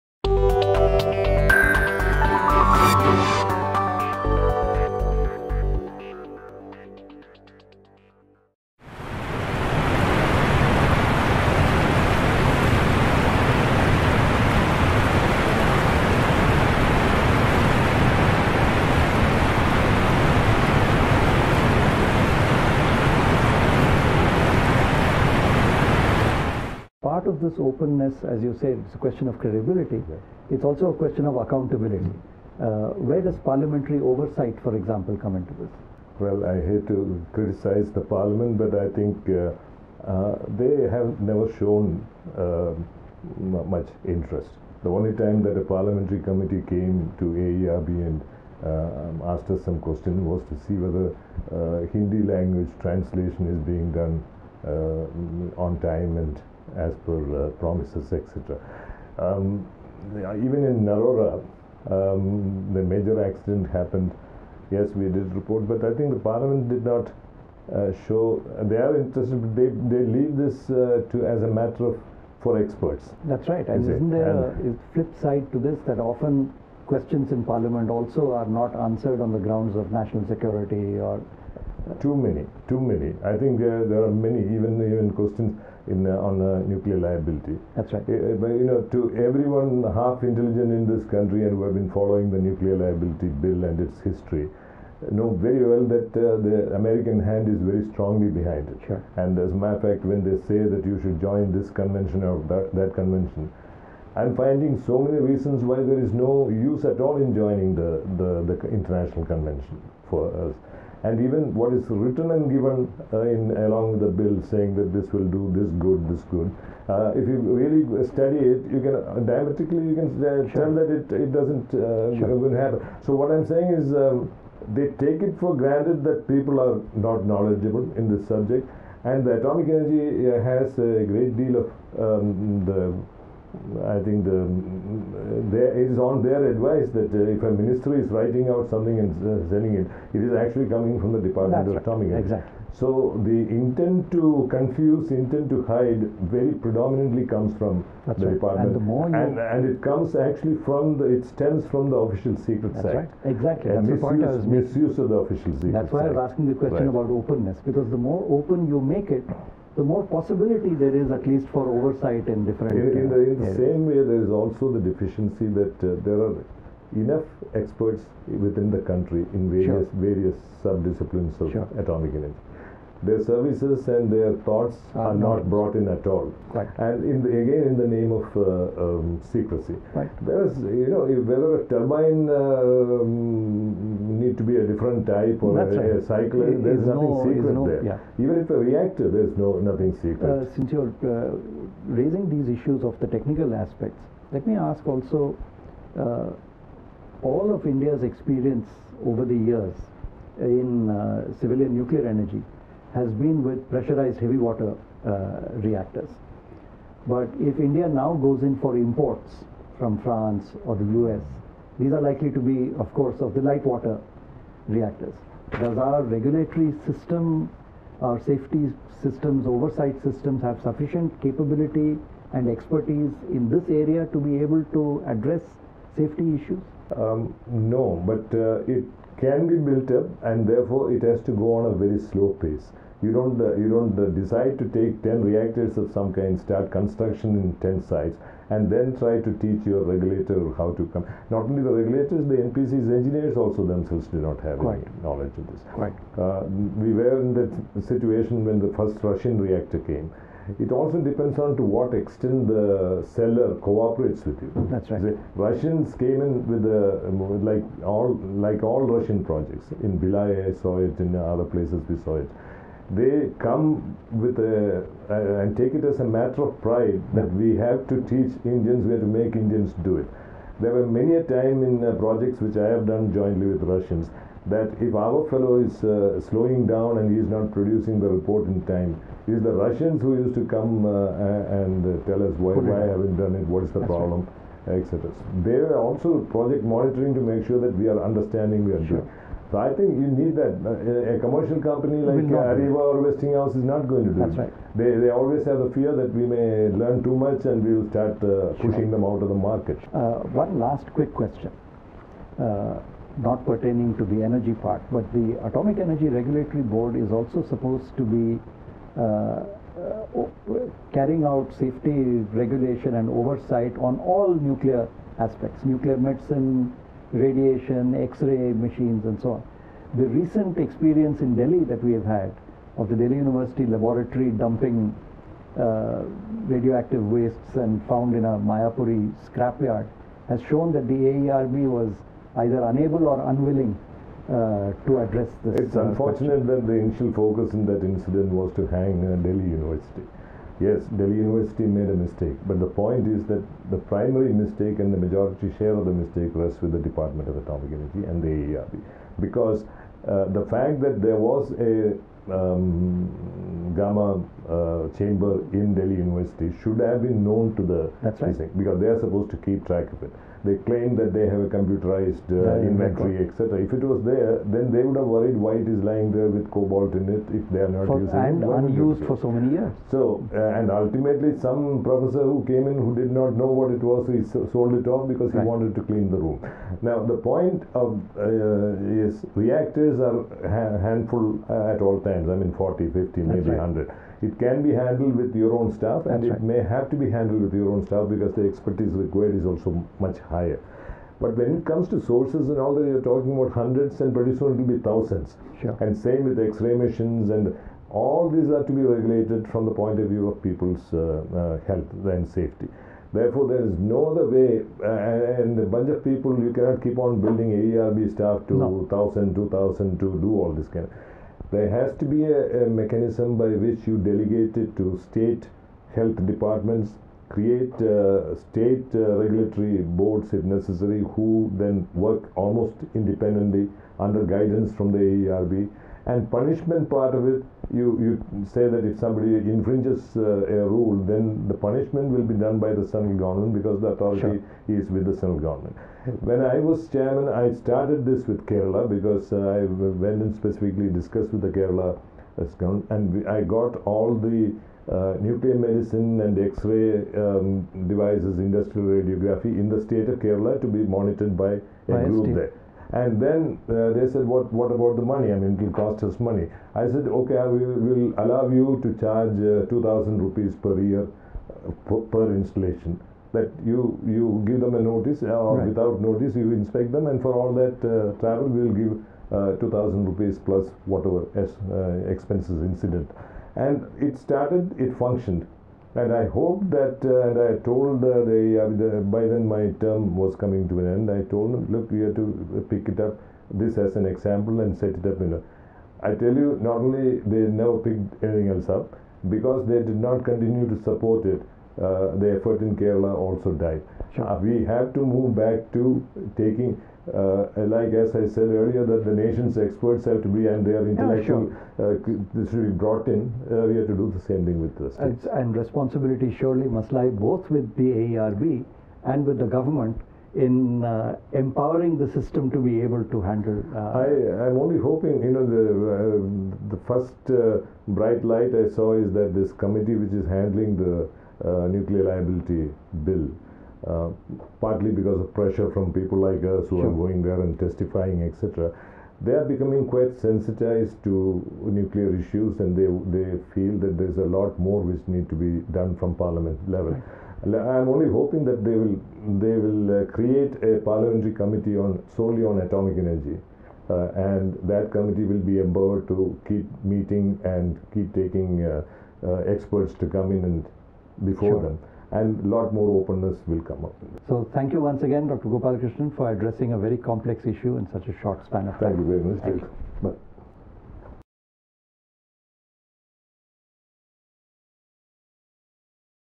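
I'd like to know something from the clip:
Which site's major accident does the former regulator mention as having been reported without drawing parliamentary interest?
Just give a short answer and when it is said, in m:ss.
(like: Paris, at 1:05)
Narora, at 1:00.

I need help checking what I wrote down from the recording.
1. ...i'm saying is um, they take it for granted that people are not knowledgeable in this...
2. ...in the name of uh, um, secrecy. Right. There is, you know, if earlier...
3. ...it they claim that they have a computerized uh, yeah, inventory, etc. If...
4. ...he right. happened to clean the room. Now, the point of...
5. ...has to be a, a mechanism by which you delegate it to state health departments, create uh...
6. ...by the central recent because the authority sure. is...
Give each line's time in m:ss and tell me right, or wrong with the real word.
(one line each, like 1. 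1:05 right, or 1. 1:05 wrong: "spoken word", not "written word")
1. 2:03 right
2. 2:57 wrong: "whether", not "earlier"
3. 6:00 right
4. 6:15 wrong: "wanted", not "happened"
5. 6:51 right
6. 7:12 wrong: "government", not "recent".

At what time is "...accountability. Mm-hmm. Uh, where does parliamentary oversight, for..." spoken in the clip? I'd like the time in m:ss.
0:31.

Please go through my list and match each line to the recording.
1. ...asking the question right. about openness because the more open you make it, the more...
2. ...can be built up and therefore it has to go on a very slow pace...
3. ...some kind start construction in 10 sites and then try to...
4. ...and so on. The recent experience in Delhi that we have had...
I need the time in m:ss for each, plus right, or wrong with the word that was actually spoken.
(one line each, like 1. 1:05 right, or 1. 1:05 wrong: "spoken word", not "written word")
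1. 2:36 right
2. 3:49 right
3. 3:55 right
4. 5:19 right.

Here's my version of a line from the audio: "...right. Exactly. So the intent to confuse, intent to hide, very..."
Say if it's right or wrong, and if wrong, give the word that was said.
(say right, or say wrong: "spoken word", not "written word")
right.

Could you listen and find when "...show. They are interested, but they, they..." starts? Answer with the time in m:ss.
1:08.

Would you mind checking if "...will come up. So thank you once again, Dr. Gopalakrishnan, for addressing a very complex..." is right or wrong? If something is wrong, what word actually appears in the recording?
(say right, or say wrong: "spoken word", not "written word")
right.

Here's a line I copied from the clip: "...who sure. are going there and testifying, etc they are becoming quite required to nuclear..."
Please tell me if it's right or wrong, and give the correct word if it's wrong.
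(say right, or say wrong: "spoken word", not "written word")
wrong: "sensitized", not "required".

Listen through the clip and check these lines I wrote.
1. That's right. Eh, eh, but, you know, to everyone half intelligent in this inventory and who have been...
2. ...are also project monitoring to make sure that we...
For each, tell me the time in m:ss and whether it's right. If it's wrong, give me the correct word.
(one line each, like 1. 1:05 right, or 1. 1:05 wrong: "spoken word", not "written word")
1. 1:27 wrong: "country", not "inventory"
2. 4:45 right.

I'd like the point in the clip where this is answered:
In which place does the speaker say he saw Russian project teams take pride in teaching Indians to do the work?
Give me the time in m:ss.
4:19.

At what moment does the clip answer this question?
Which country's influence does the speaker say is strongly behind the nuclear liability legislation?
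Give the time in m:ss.
1:36.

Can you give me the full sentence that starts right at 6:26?
may have to be handled with your own staff because the expertise required is also much higher.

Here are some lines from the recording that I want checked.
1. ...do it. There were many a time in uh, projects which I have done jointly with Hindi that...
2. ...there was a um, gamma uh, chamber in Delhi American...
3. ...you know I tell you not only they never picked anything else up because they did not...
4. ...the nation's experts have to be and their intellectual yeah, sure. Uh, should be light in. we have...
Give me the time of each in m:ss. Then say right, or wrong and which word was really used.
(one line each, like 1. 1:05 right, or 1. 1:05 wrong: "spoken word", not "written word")
1. 4:29 wrong: "Russians", not "Hindi"
2. 5:51 wrong: "University", not "American"
3. 8:05 right
4. 8:19 wrong: "brought", not "light".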